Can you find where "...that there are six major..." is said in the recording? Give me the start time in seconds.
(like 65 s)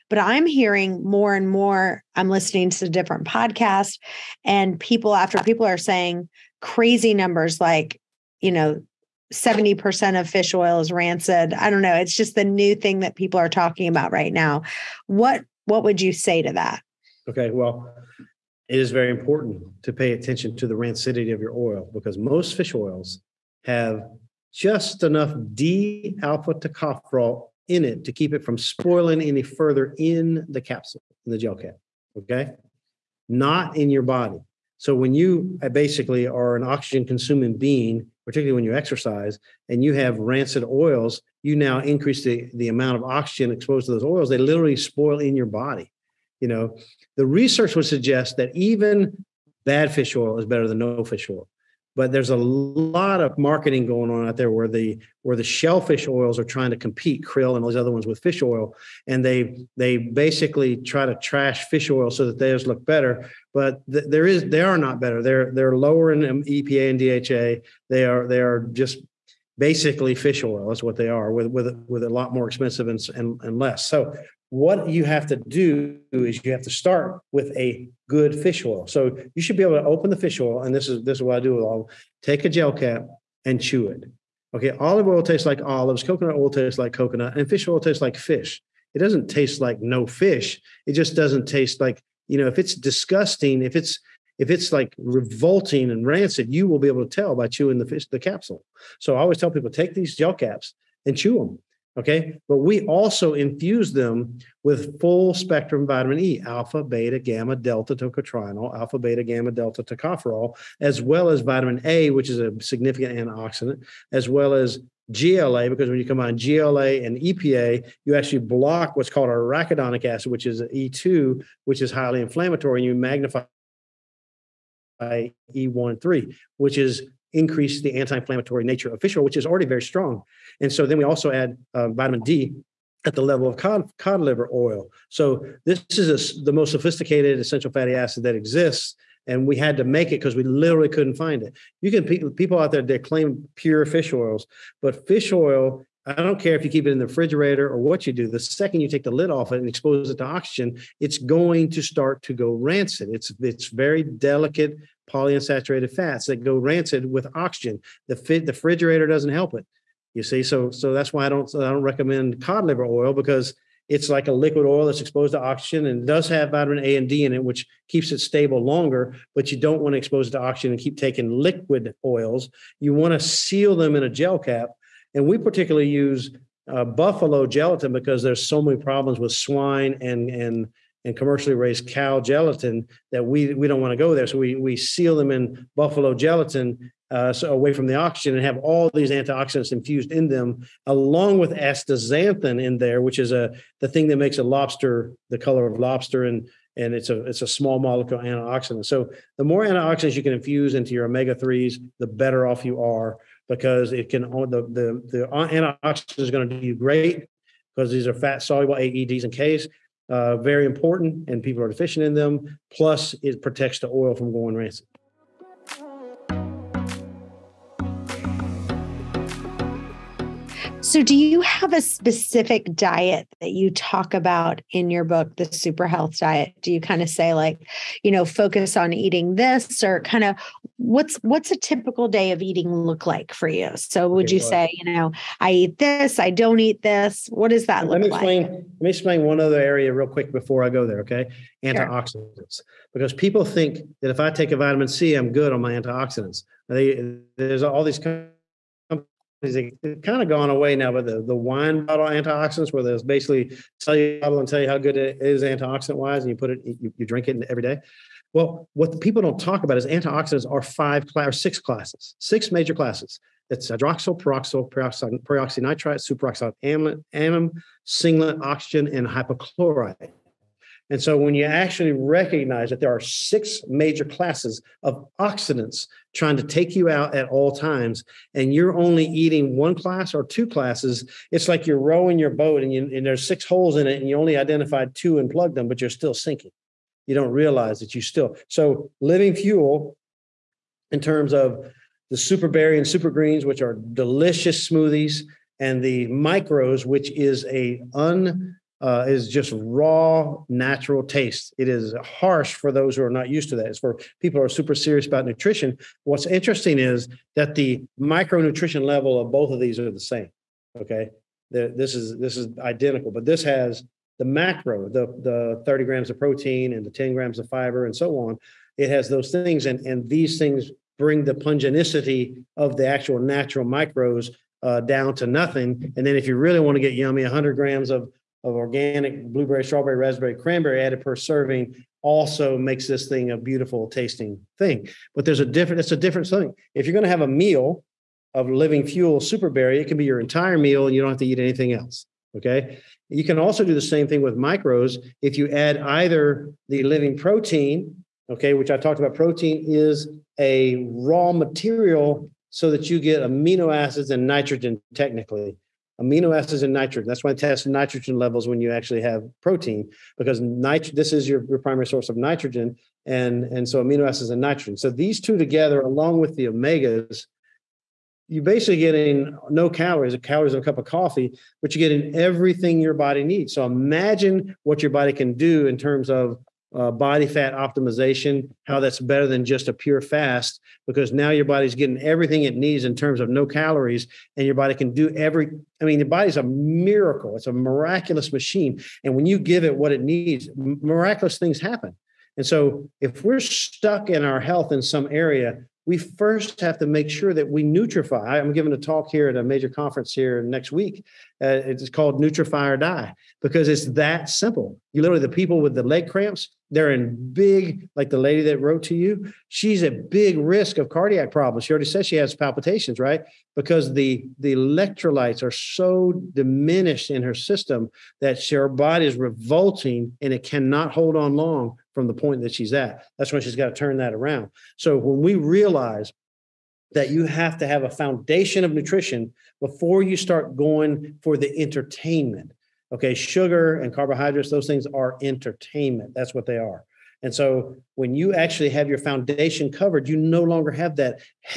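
272 s.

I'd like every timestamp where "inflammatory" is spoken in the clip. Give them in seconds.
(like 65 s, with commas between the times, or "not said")
122 s, 127 s.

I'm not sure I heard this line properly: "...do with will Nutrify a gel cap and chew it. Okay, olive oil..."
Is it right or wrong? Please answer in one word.
wrong.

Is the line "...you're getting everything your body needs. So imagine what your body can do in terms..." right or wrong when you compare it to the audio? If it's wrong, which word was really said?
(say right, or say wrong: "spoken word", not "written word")
right.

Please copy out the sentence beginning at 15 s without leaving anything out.
What what would you say to that?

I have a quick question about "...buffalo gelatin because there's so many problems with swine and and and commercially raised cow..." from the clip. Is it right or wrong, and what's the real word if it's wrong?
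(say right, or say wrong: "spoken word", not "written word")
right.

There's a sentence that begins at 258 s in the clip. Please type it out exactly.
Well, what the people don't talk about is antioxidants are five or six classes, six major classes.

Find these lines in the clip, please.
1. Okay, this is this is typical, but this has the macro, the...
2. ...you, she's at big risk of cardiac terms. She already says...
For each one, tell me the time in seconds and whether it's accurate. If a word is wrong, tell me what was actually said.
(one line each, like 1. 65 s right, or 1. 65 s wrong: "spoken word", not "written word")
1. 310 s wrong: "identical", not "typical"
2. 408 s wrong: "problems", not "terms".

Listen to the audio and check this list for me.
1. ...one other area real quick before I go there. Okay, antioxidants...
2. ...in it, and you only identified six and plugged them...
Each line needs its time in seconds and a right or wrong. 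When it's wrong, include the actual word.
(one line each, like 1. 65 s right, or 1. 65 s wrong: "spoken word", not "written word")
1. 239 s right
2. 283 s wrong: "two", not "six".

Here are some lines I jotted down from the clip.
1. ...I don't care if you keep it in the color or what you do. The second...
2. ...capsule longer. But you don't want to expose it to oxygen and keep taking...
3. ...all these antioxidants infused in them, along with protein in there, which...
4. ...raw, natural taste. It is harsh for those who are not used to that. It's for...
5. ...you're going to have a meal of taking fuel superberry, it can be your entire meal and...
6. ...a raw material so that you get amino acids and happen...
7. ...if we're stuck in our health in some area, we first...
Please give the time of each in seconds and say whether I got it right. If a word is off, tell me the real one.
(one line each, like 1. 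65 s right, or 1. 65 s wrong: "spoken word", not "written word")
1. 146 s wrong: "refrigerator", not "color"
2. 168 s wrong: "stable", not "capsule"
3. 188 s wrong: "astaxanthin", not "protein"
4. 299 s right
5. 336 s wrong: "living", not "taking"
6. 350 s wrong: "nitrogen", not "happen"
7. 393 s right.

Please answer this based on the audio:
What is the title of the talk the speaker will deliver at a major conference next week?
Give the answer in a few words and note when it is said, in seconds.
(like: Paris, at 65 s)
Nutrify or Die, at 402 s.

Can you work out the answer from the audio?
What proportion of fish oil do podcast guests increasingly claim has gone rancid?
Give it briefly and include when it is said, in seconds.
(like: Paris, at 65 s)
70%, at 9 s.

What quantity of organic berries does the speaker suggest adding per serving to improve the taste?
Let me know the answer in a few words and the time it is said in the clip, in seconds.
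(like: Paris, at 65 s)
100 grams, at 327 s.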